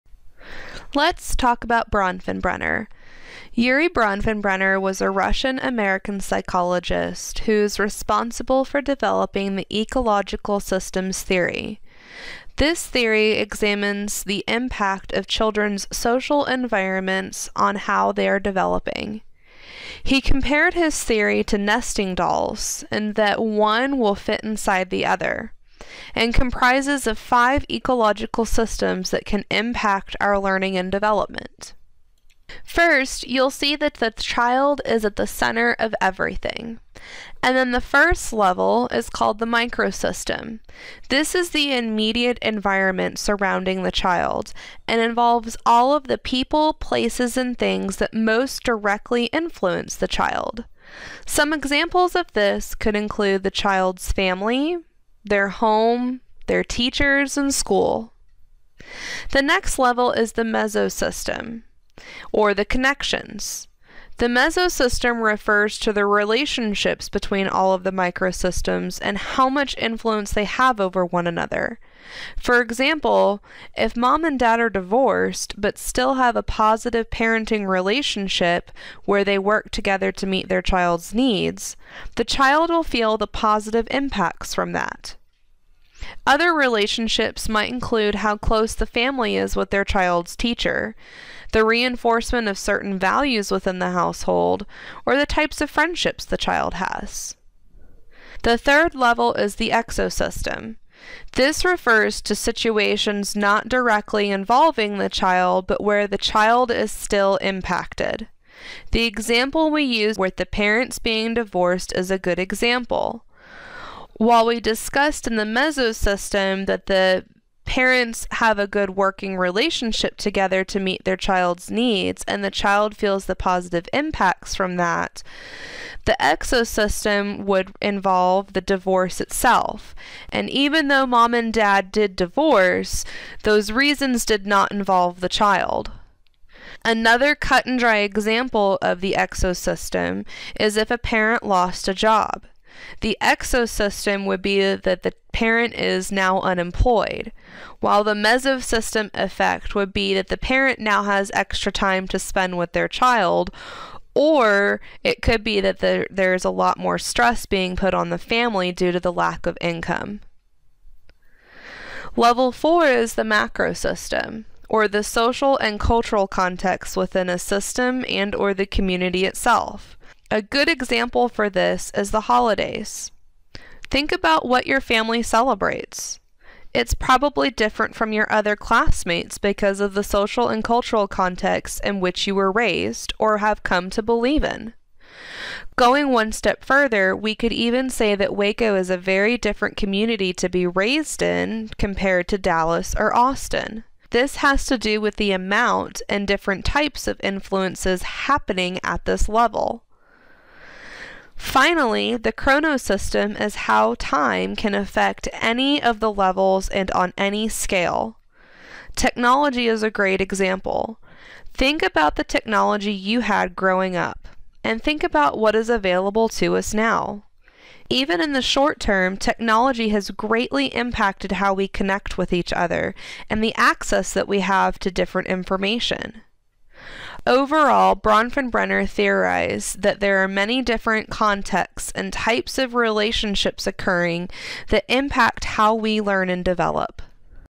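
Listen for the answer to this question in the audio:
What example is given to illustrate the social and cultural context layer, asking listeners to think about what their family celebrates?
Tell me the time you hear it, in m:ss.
2:52.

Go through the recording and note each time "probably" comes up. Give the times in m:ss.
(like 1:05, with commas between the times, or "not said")
2:56.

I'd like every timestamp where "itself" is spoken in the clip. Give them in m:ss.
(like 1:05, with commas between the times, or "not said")
2:09, 2:49.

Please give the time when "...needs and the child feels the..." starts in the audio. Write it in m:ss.
2:01.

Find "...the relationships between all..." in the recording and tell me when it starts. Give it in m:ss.
1:05.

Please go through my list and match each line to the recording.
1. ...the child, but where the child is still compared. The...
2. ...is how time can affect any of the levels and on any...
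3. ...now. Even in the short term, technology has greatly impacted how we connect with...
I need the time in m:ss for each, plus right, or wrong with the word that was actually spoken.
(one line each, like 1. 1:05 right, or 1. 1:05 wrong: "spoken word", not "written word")
1. 1:44 wrong: "impacted", not "compared"
2. 3:23 right
3. 3:36 right.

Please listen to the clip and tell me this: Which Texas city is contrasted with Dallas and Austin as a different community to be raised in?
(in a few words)
Waco.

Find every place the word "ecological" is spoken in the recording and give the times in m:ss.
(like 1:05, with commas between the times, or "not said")
0:09, 0:27.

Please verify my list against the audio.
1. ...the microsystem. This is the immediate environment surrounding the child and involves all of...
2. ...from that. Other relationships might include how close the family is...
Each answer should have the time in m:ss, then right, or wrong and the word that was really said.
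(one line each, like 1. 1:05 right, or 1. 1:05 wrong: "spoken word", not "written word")
1. 0:39 right
2. 1:24 right.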